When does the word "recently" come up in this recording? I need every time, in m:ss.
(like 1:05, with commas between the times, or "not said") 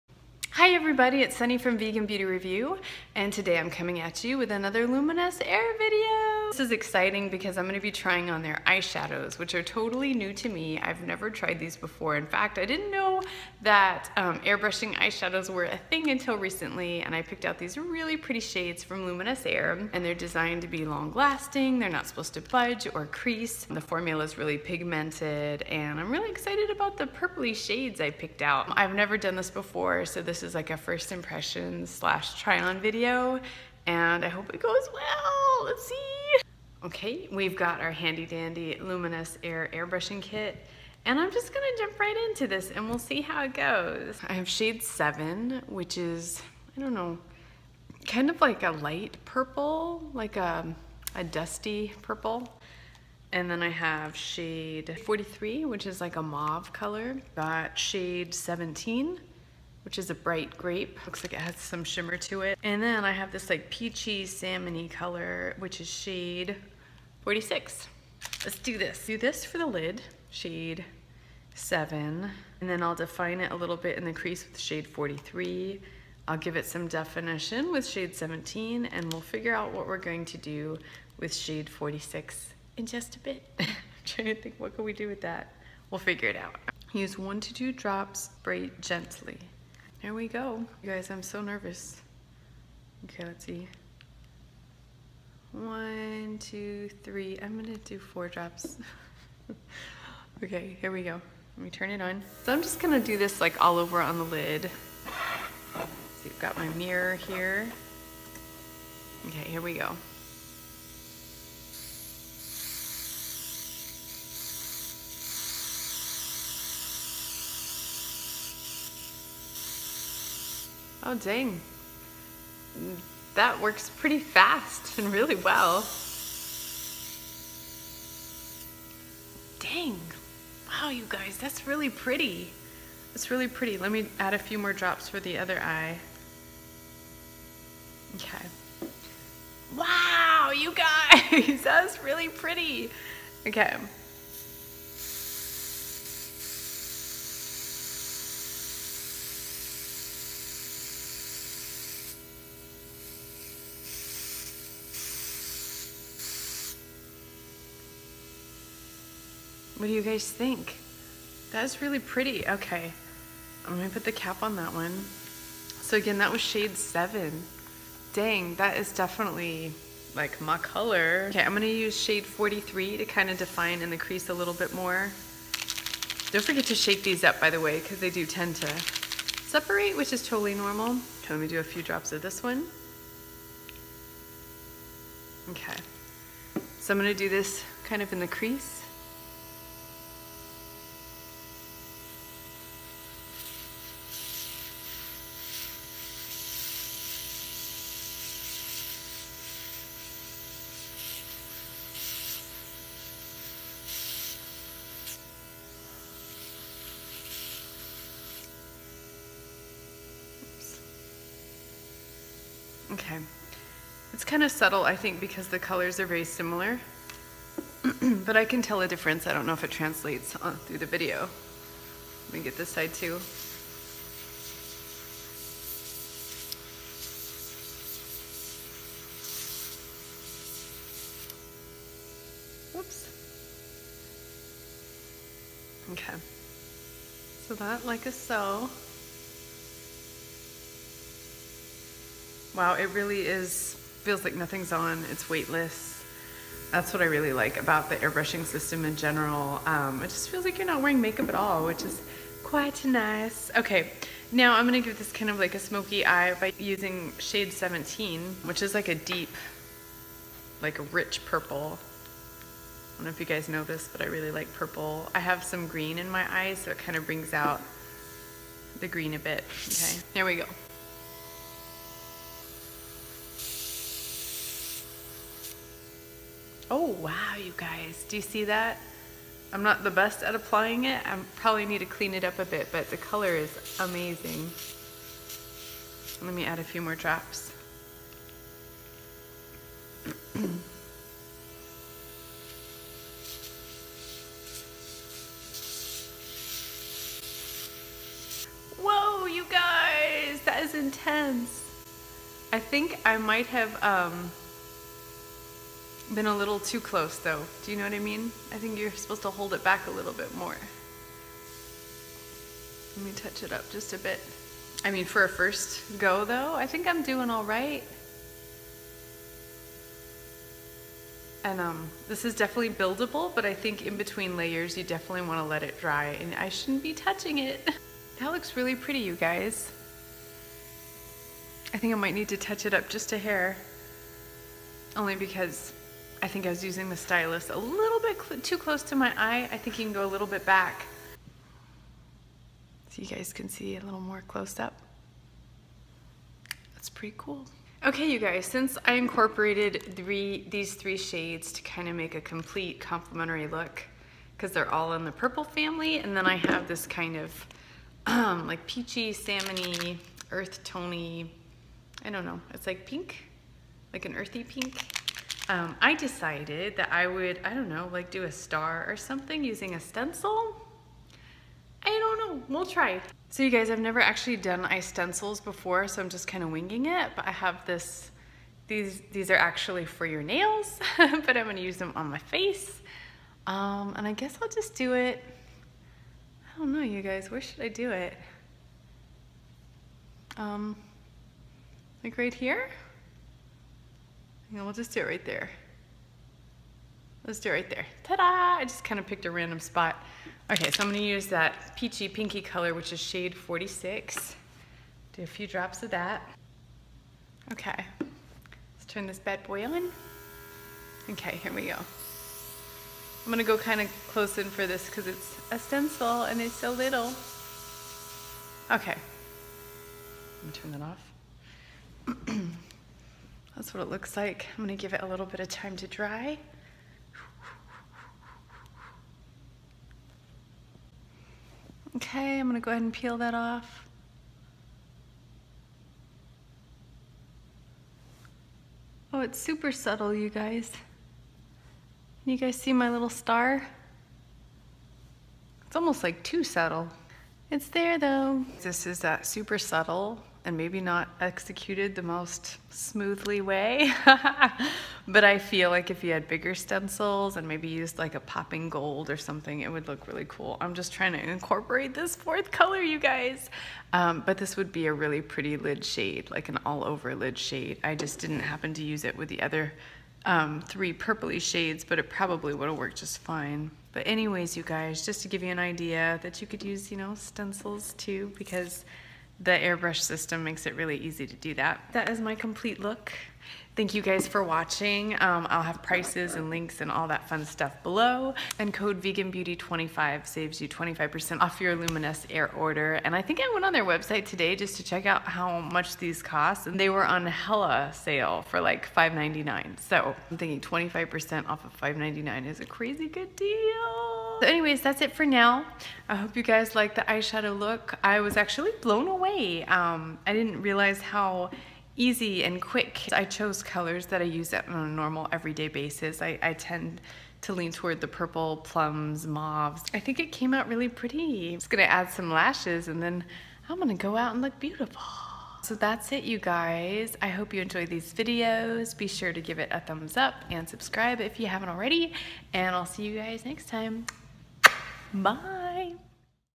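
0:16.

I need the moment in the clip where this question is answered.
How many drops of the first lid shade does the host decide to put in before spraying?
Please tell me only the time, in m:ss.
1:37.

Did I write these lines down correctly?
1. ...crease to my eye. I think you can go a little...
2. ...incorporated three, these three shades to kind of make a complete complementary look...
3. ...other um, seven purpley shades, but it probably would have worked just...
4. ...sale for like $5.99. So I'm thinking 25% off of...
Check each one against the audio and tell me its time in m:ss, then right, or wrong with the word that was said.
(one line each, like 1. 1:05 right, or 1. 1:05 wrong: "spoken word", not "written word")
1. 5:38 wrong: "close", not "crease"
2. 5:48 right
3. 7:49 wrong: "three", not "seven"
4. 8:17 right.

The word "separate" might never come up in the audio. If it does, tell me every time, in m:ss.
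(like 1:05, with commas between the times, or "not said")
2:59.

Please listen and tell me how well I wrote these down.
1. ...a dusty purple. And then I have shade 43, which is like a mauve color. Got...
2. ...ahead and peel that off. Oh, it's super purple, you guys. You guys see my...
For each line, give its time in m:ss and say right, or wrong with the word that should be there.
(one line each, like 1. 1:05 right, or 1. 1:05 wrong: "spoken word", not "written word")
1. 0:51 right
2. 7:12 wrong: "subtle", not "purple".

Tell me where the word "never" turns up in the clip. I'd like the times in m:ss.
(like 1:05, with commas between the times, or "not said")
0:11, 0:28, 6:13.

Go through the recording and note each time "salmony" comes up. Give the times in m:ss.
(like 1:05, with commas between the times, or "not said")
1:04, 5:59.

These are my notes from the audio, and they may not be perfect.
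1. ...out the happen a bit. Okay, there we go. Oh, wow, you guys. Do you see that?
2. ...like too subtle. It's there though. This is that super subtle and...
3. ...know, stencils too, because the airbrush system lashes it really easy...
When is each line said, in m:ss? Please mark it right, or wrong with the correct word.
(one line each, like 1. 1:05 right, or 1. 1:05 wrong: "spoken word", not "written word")
1. 4:27 wrong: "green", not "happen"
2. 7:26 right
3. 7:56 wrong: "makes", not "lashes".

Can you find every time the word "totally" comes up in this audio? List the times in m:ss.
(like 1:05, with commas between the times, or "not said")
0:09, 3:00.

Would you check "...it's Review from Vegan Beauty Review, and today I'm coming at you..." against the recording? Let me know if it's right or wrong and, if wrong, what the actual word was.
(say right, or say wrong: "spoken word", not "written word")
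wrong: "Sunny", not "Review".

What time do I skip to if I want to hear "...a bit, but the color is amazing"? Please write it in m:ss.
4:42.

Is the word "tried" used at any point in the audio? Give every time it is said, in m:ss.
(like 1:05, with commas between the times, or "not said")
0:11.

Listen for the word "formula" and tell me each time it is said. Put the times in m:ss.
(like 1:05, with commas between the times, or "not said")
0:23.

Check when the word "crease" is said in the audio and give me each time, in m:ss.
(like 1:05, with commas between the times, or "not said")
0:23, 1:14, 2:53, 3:08.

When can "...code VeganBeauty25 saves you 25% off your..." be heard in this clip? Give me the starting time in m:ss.
8:08.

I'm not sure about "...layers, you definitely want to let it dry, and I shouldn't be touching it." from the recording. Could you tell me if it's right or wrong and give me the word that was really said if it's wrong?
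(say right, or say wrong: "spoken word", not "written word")
right.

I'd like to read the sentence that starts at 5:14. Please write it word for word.
I mean, for a first go, though, I think I'm doing all right.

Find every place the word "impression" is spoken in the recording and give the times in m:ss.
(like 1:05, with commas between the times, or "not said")
0:31.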